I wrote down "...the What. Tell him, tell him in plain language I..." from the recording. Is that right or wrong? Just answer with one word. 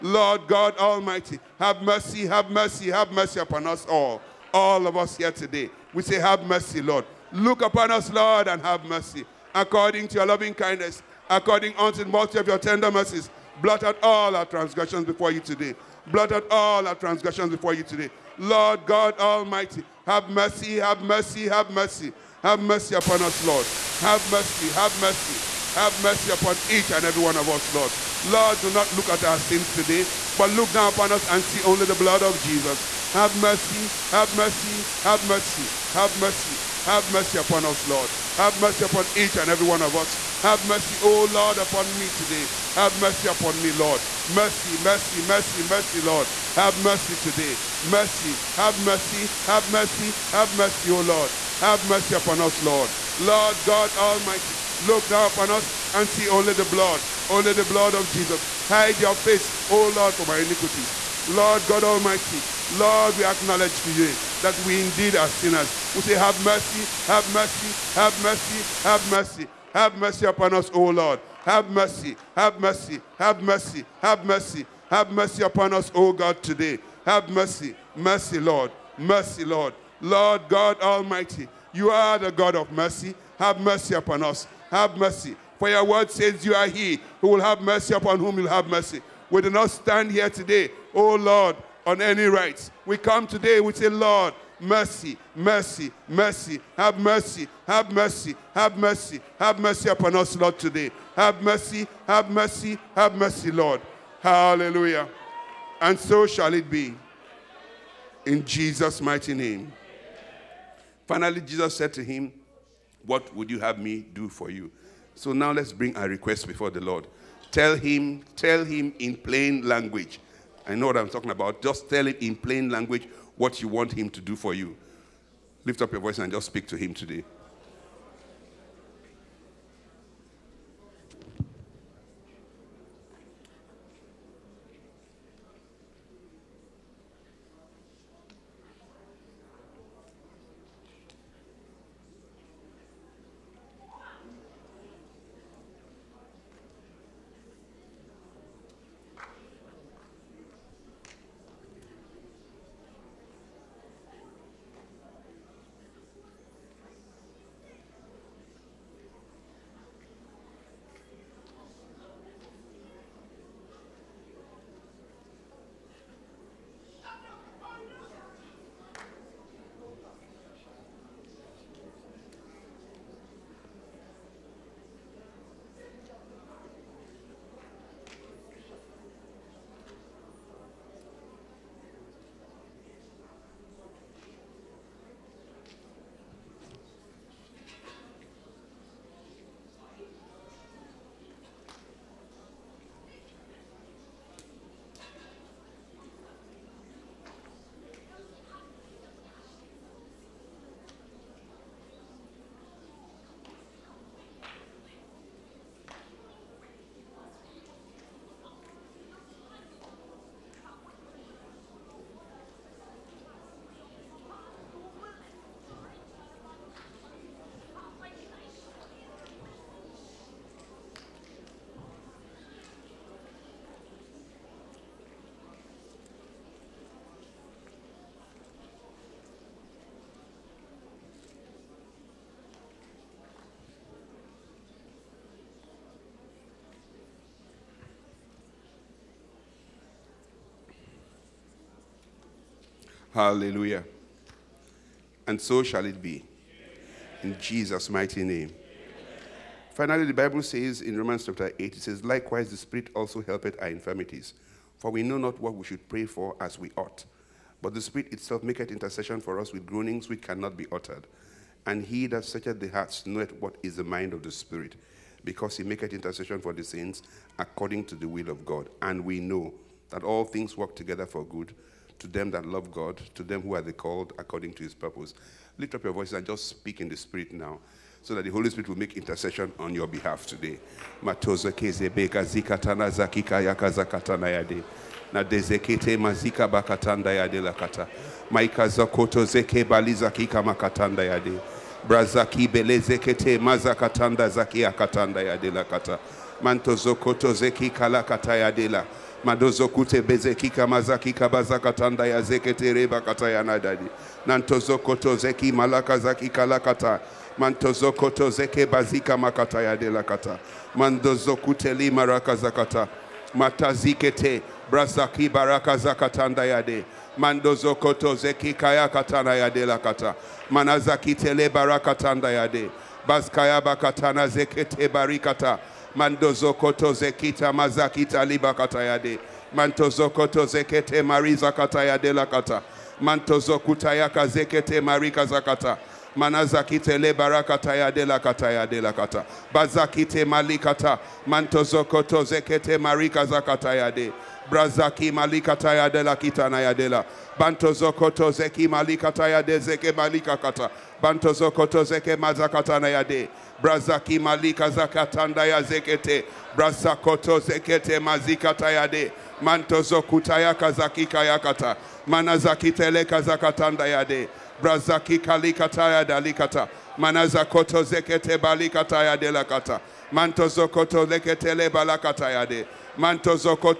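wrong.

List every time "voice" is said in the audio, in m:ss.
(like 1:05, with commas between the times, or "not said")
2:06, 4:35.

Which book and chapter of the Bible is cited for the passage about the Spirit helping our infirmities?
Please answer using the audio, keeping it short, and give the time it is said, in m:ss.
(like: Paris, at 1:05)
Romans chapter 8, at 4:10.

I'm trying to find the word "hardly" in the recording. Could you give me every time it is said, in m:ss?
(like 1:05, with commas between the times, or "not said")
not said.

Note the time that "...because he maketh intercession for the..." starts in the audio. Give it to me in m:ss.
4:25.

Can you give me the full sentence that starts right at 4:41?
Matoza kezebeka zikatana zakika yakazakatana yade.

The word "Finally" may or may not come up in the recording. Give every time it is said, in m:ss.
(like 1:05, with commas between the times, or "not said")
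1:51, 4:09.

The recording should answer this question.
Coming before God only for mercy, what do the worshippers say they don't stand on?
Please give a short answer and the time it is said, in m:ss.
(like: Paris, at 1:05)
rights, at 1:32.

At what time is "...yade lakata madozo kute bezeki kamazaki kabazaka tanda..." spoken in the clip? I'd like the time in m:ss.
4:58.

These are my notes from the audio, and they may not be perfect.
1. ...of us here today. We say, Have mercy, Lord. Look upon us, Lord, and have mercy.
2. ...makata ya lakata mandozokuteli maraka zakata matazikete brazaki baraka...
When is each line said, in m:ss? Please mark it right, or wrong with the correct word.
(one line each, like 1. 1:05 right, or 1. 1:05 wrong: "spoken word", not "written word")
1. 0:04 right
2. 5:09 wrong: "delakata", not "lakata".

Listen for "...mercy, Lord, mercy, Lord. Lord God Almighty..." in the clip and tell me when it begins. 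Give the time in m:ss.
1:17.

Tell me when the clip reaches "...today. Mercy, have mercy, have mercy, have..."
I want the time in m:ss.
0:47.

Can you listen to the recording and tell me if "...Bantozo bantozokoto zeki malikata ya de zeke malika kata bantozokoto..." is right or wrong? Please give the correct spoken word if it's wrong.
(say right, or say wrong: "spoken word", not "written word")
right.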